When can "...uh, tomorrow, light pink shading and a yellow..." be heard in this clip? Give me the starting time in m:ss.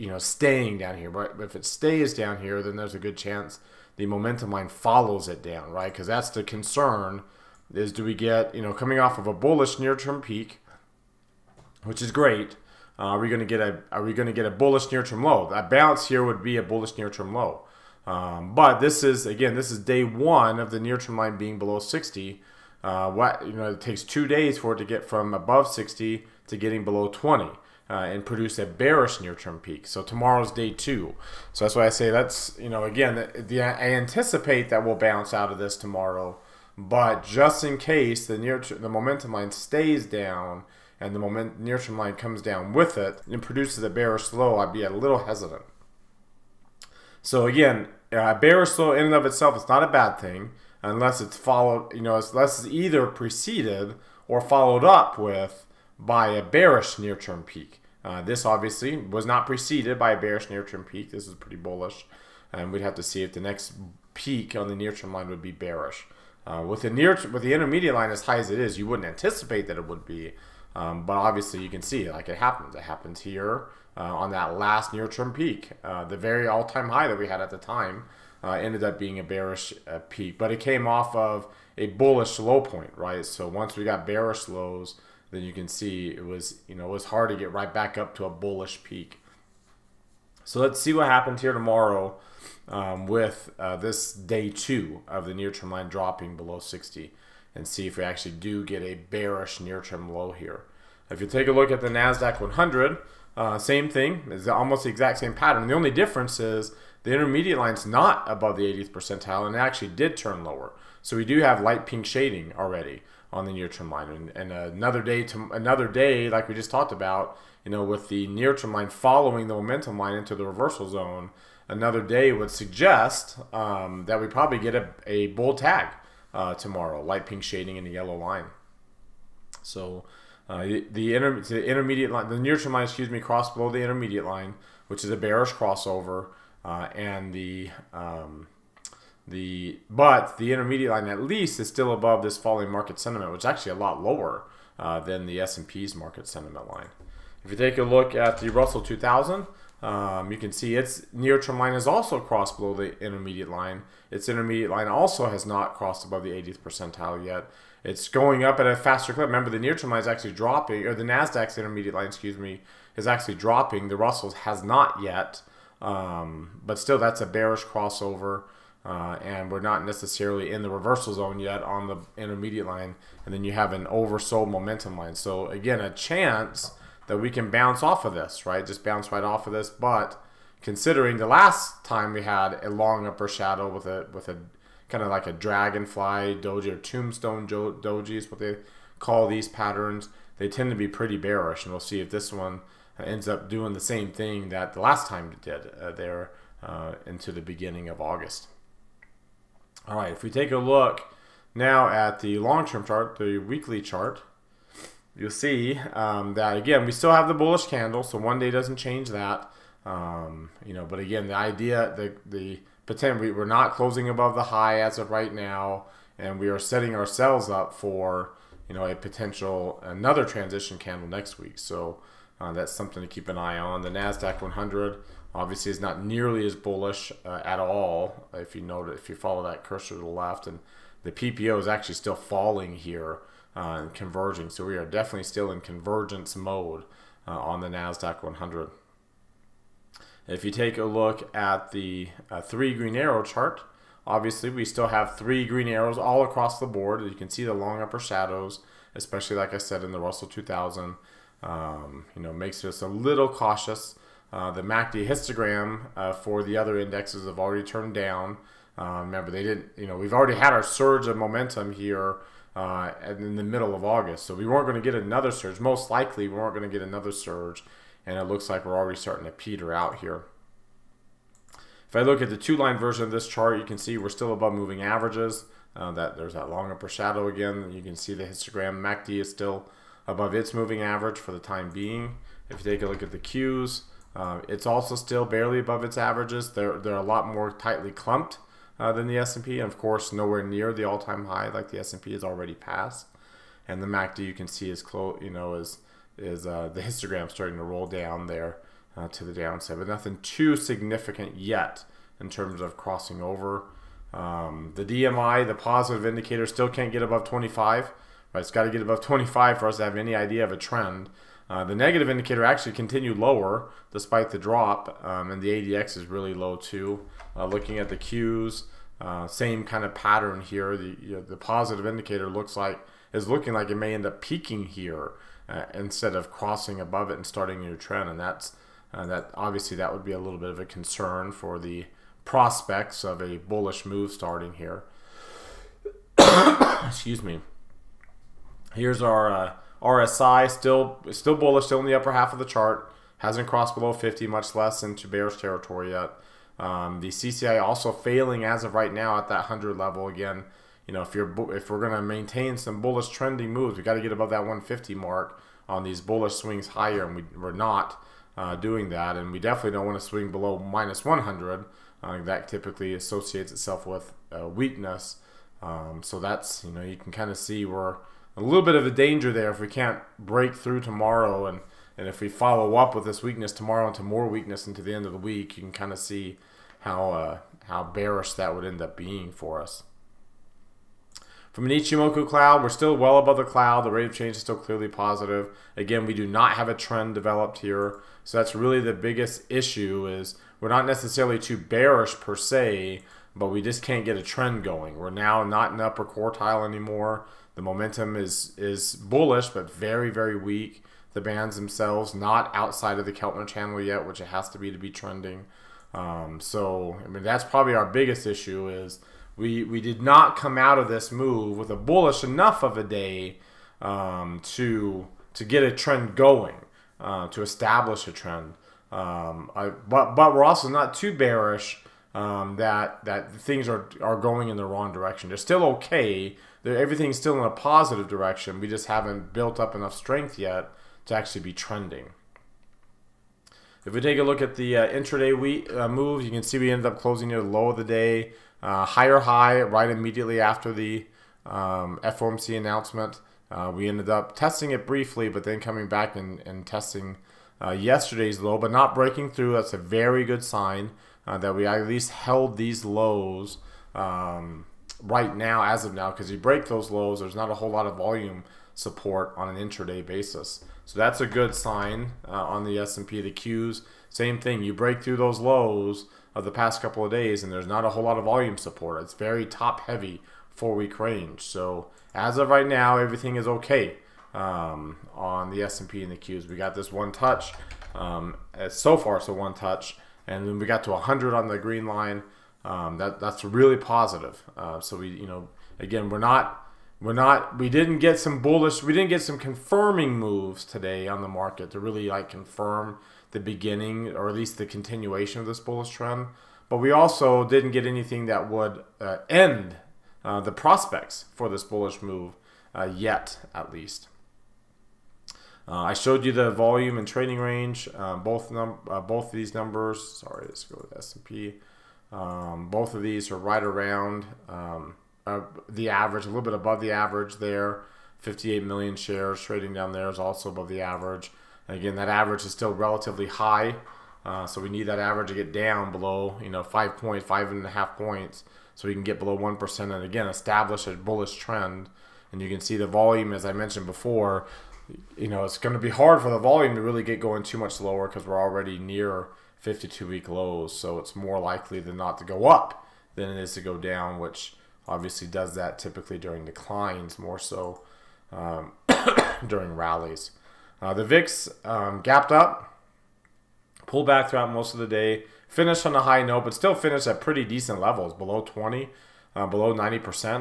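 2:06.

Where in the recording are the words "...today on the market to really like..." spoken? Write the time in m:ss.
8:10.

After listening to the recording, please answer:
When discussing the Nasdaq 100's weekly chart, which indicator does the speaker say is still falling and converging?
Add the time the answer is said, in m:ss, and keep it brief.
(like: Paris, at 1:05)
PPO, at 3:51.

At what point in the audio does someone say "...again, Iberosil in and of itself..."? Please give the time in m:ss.
0:47.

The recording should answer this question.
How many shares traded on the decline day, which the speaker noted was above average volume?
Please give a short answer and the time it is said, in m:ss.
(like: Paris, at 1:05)
58 million, at 8:38.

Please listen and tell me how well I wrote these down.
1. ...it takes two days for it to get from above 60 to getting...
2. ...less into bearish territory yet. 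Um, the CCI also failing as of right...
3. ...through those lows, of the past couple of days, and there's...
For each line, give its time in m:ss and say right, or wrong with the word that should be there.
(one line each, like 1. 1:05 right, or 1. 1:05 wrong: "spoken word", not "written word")
1. 0:23 right
2. 5:44 right
3. 7:45 right.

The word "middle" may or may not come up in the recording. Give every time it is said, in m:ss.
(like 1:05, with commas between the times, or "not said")
4:23.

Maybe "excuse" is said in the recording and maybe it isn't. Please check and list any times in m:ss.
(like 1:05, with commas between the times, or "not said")
2:12, 2:42, 5:36.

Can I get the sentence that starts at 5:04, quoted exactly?
Um, the DMI, the positive indicator, still can't get above 25.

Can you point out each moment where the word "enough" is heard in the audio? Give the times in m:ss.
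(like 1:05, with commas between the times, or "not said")
6:52, 7:09.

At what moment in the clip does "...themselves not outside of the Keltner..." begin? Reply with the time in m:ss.
6:41.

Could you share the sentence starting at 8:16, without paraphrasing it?
But we also didn't get anything that would uh, end uh, the prospects for this bullish move uh, yet, at least.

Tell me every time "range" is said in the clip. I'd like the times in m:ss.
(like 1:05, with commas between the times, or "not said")
7:50, 8:27.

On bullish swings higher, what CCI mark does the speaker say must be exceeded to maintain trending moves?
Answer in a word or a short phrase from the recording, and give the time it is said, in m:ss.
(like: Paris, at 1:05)
150, at 5:54.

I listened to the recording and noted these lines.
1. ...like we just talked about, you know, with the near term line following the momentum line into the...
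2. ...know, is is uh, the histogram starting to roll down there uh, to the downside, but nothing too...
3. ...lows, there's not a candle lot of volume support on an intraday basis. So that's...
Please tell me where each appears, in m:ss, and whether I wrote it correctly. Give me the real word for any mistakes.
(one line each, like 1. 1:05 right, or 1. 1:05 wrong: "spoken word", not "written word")
1. 1:56 right
2. 4:55 right
3. 7:36 wrong: "whole", not "candle".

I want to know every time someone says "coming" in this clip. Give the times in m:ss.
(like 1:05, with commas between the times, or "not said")
0:08, 7:25.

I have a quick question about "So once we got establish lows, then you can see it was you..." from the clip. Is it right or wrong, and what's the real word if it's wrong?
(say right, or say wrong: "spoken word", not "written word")
wrong: "bearish", not "establish".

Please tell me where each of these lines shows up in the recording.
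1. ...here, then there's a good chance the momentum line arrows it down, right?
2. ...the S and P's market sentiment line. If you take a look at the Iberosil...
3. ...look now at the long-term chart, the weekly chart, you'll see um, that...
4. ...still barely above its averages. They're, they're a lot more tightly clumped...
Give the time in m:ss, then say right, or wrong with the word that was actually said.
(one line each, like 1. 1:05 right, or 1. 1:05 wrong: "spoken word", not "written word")
1. 0:02 wrong: "follows", not "arrows"
2. 2:25 wrong: "Russell", not "Iberosil"
3. 3:20 right
4. 4:44 right.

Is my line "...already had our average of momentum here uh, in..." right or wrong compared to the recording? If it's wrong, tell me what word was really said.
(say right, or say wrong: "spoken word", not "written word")
wrong: "surge", not "average".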